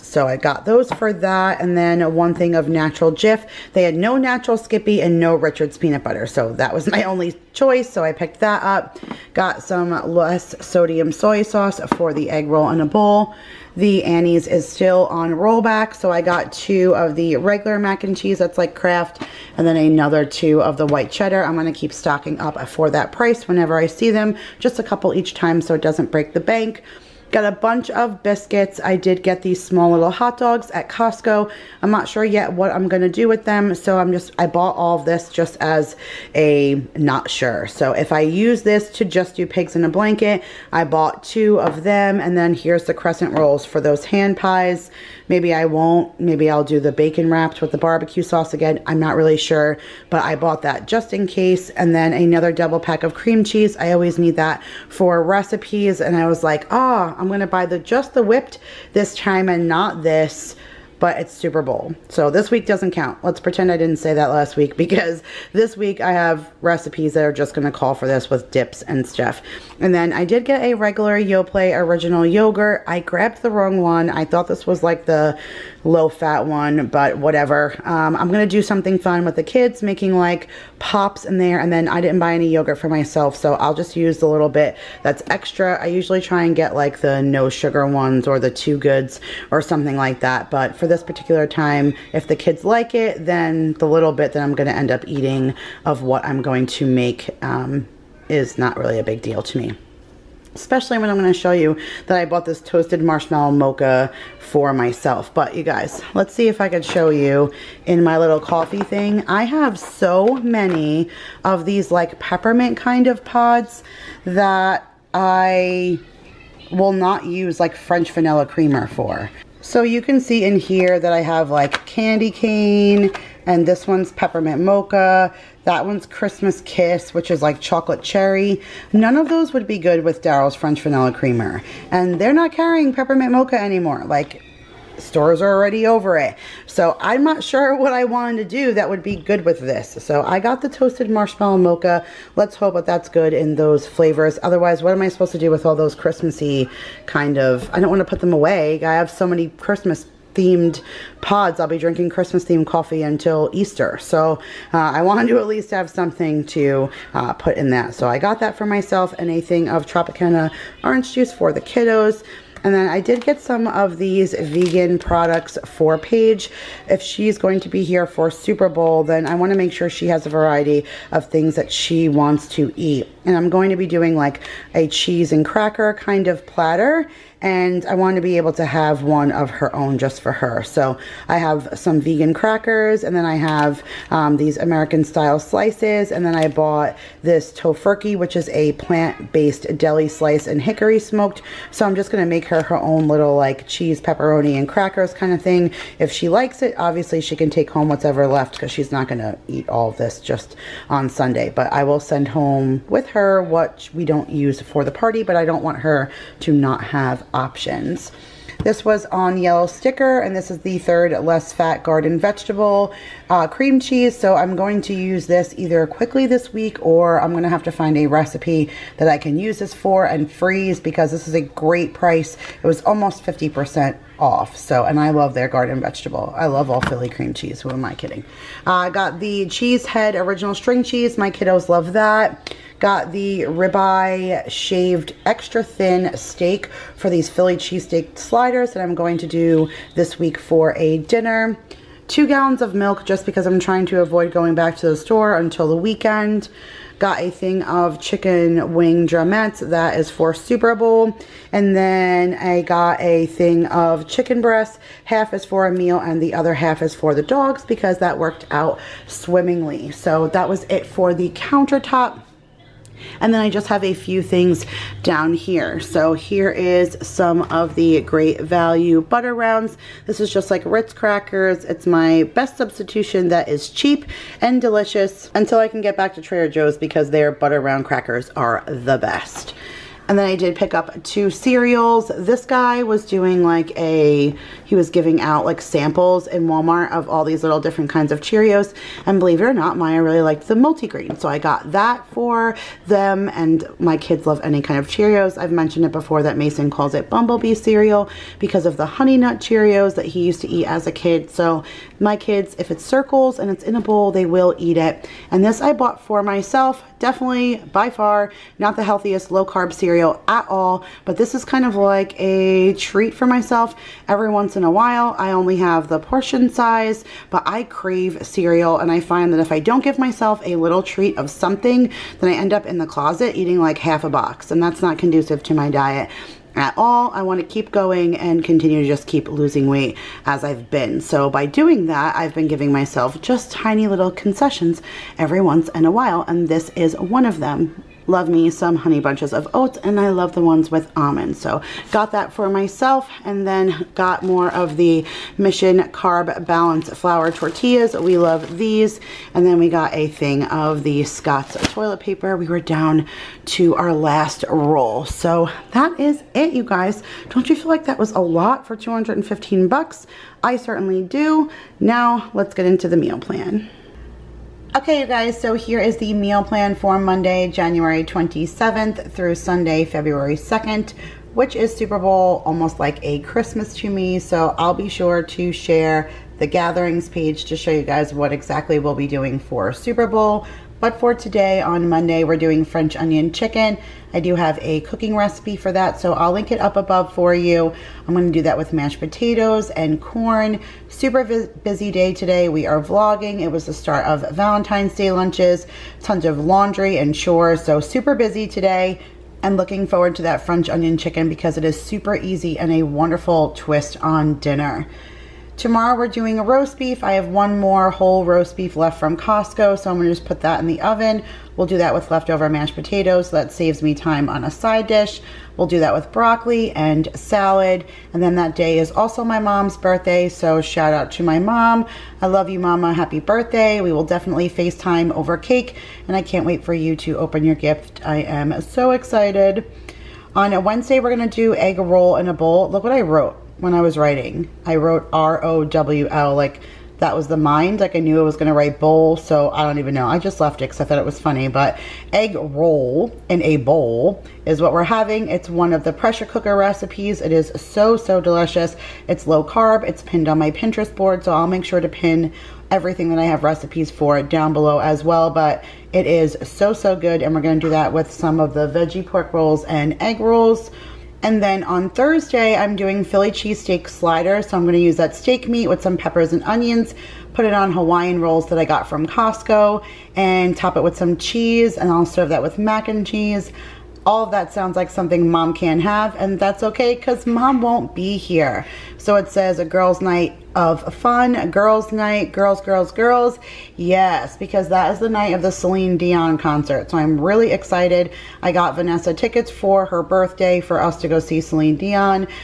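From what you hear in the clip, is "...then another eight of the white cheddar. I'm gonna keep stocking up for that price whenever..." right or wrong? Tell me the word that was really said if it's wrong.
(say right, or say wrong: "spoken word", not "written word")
wrong: "two", not "eight".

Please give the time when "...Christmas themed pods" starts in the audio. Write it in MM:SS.
02:29.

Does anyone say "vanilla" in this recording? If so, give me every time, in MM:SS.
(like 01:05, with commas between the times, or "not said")
01:58, 02:10.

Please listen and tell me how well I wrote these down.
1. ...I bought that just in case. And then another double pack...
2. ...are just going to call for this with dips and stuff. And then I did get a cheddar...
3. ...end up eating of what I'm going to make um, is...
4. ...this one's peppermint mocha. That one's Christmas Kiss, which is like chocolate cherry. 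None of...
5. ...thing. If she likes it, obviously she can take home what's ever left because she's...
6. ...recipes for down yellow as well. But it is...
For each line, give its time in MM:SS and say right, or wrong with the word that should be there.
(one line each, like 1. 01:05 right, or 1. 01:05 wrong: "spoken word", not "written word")
1. 00:50 right
2. 01:07 wrong: "regular", not "cheddar"
3. 01:34 right
4. 02:03 right
5. 03:15 right
6. 07:33 wrong: "below", not "yellow".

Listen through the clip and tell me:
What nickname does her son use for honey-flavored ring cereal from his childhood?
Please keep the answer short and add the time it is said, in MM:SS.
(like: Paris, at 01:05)
Bumblebee cereal, at 04:57.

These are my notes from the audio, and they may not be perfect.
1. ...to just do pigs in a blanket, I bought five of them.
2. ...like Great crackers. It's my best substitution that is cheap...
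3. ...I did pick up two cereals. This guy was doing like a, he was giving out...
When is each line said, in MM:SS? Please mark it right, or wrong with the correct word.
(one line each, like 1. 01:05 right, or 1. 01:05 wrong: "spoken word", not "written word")
1. 00:38 wrong: "two", not "five"
2. 04:30 wrong: "Ritz", not "Great"
3. 04:40 right.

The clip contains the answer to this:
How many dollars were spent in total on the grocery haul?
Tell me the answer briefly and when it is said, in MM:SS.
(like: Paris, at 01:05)
215, at 05:58.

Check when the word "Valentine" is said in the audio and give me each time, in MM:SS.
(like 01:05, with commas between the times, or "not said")
06:34.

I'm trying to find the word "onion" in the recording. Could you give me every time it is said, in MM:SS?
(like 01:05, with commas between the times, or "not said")
06:22, 06:40, 07:46.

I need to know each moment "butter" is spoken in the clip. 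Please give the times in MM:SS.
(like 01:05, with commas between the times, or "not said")
00:06, 04:29, 04:37.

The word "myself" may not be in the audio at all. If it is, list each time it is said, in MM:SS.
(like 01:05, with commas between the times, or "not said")
01:22, 01:44, 02:38, 05:06, 05:13, 05:19, 05:32, 05:42.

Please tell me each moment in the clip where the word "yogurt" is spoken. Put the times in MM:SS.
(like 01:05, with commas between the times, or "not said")
01:12, 01:22.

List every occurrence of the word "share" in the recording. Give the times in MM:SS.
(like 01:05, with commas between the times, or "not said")
06:15.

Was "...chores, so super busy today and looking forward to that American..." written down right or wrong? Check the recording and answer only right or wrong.
wrong.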